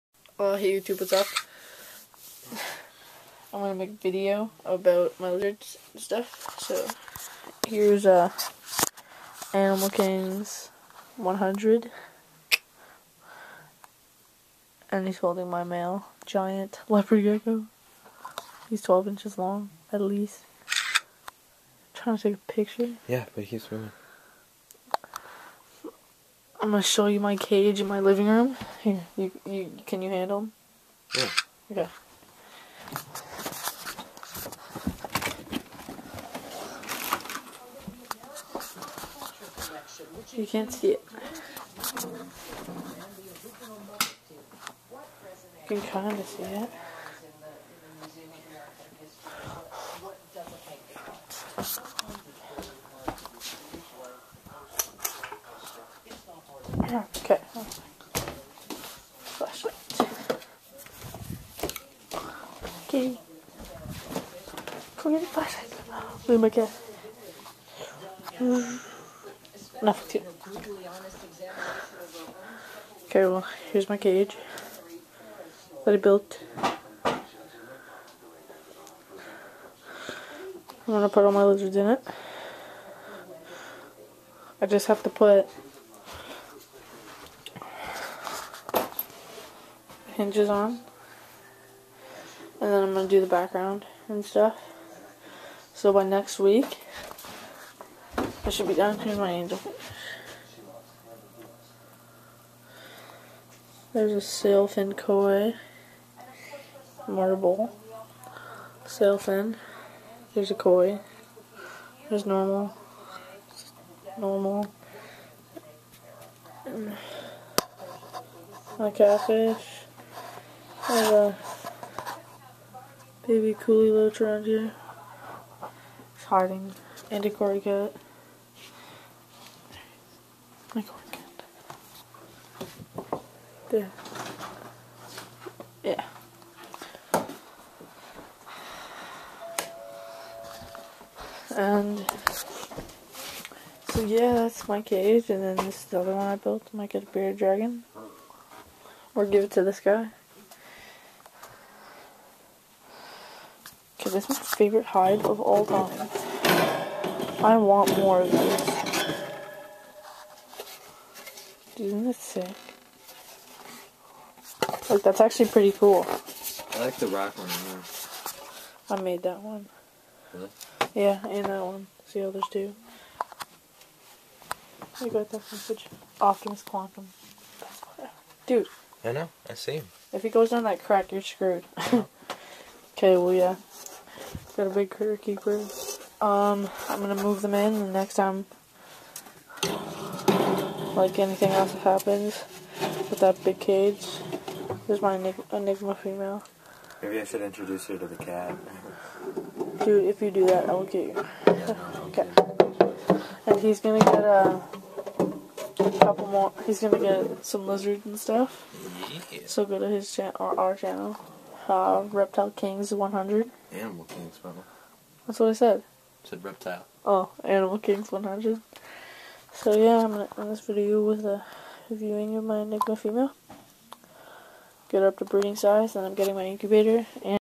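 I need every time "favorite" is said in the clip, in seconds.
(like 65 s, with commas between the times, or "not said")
154 s.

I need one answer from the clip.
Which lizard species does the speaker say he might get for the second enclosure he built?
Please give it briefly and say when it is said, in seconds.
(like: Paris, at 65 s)
bearded dragon, at 147 s.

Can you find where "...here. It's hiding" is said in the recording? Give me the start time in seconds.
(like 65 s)
124 s.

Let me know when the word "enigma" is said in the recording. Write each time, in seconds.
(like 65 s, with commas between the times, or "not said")
195 s, 222 s.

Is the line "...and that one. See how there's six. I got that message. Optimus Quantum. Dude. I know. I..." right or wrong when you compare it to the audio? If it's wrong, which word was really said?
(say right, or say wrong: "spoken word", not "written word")
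wrong: "two", not "six".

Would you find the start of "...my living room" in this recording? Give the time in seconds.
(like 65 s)
27 s.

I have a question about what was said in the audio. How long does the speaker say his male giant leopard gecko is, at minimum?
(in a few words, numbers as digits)
12 inches.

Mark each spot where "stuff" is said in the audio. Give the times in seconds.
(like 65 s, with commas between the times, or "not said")
5 s, 94 s, 208 s.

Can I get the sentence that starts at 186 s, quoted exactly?
Um, I'm gonna move them in the next time, like anything else happens with that big cage.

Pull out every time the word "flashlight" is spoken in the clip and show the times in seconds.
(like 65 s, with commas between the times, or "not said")
59 s, 65 s.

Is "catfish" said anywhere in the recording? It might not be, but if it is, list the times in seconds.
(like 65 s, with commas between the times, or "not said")
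118 s.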